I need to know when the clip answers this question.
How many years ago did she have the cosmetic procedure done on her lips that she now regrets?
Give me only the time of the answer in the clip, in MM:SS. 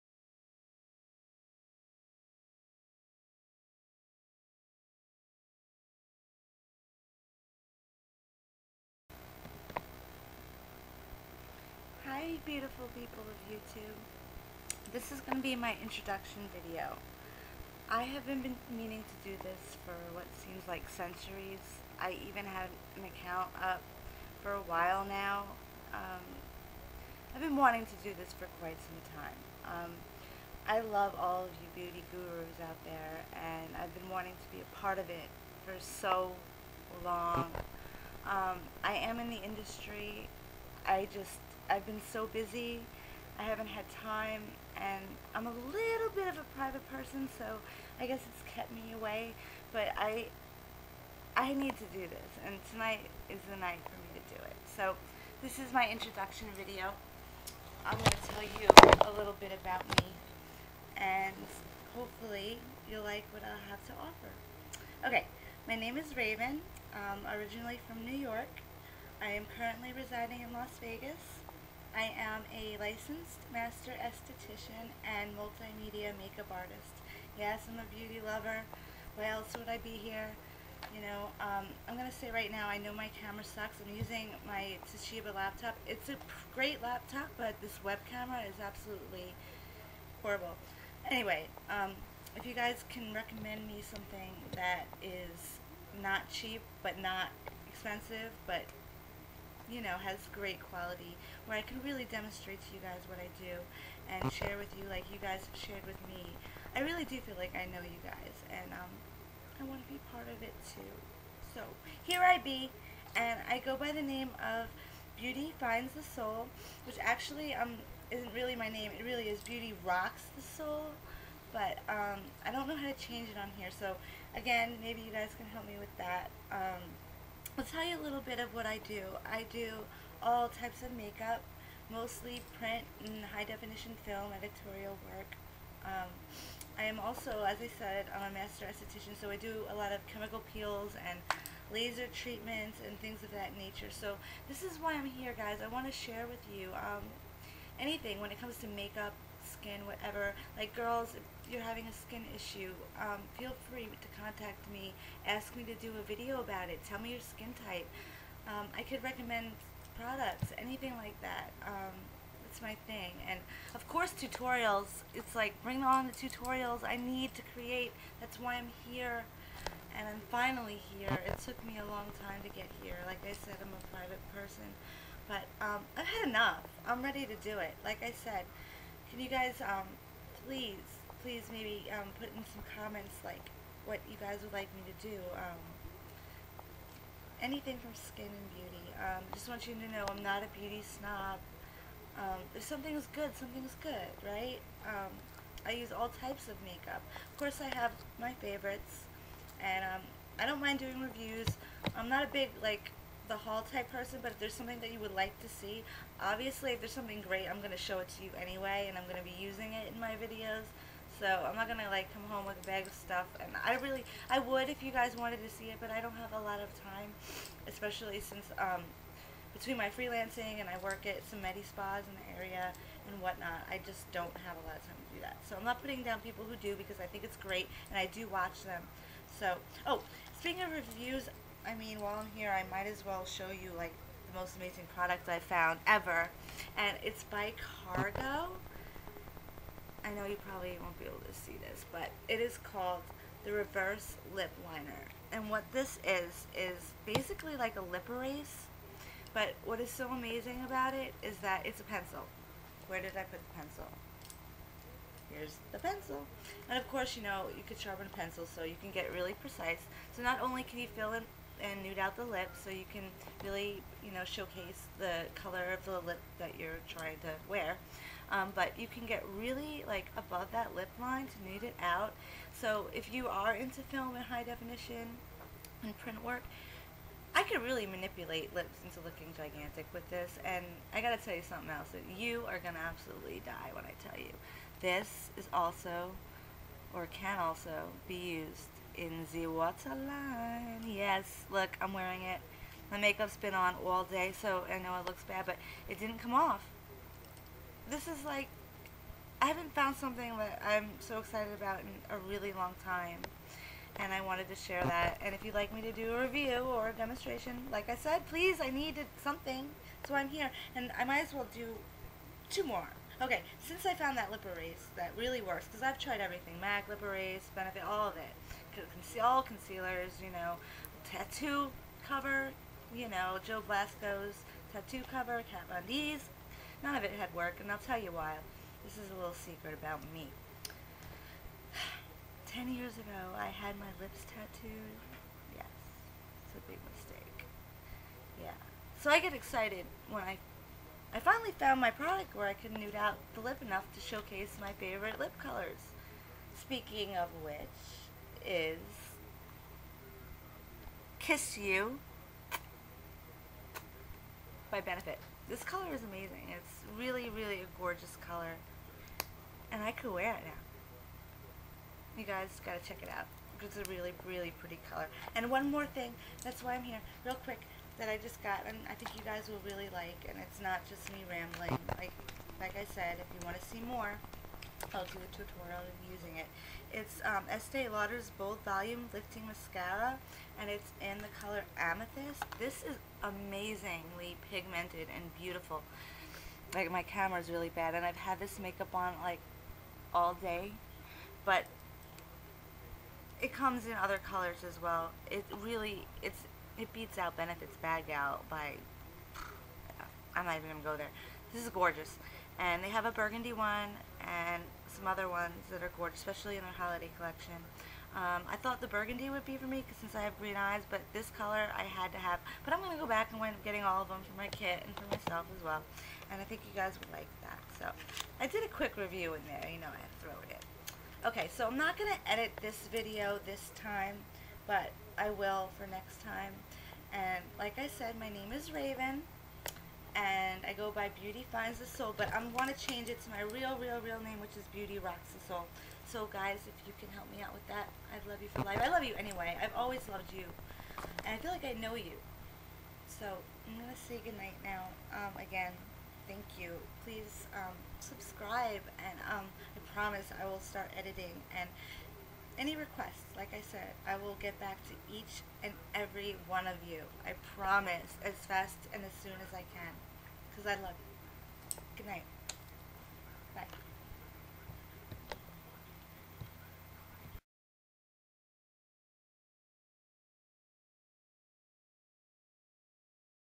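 05:32.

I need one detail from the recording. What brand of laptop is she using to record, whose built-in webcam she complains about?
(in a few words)
Toshiba.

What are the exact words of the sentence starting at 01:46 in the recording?
I really do feel like I know you guys, and um, I want to be part of it too.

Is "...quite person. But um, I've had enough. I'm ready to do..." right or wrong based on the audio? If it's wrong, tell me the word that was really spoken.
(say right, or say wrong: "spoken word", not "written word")
wrong: "private", not "quite".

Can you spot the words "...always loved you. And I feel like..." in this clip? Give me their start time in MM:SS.
07:19.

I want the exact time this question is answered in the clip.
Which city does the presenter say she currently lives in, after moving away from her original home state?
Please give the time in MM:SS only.
01:10.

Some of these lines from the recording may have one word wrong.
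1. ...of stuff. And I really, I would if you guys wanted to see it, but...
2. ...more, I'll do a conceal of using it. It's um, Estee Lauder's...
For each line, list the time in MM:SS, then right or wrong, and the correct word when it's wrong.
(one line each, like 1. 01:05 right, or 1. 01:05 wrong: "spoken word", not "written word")
1. 03:32 right
2. 06:13 wrong: "tutorial", not "conceal".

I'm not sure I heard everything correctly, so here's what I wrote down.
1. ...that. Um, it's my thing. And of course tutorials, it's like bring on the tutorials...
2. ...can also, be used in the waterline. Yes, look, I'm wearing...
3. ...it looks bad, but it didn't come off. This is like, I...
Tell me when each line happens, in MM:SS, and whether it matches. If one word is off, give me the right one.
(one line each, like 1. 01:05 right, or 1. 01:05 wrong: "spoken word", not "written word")
1. 02:41 right
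2. 04:47 right
3. 04:54 right.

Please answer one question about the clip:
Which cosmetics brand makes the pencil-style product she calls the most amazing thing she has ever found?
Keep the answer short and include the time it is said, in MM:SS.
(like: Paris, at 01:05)
Cargo, at 03:57.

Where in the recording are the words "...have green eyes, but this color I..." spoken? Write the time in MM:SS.
06:50.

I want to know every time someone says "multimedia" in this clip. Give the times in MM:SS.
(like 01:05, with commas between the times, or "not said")
01:15.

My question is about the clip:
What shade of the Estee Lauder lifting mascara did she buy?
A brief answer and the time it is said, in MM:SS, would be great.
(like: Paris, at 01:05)
Amethyst, at 06:21.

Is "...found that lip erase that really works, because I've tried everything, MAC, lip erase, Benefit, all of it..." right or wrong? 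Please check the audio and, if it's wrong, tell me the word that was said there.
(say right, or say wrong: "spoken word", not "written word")
right.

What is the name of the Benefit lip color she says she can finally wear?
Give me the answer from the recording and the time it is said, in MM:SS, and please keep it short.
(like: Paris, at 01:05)
Kiss You, at 05:51.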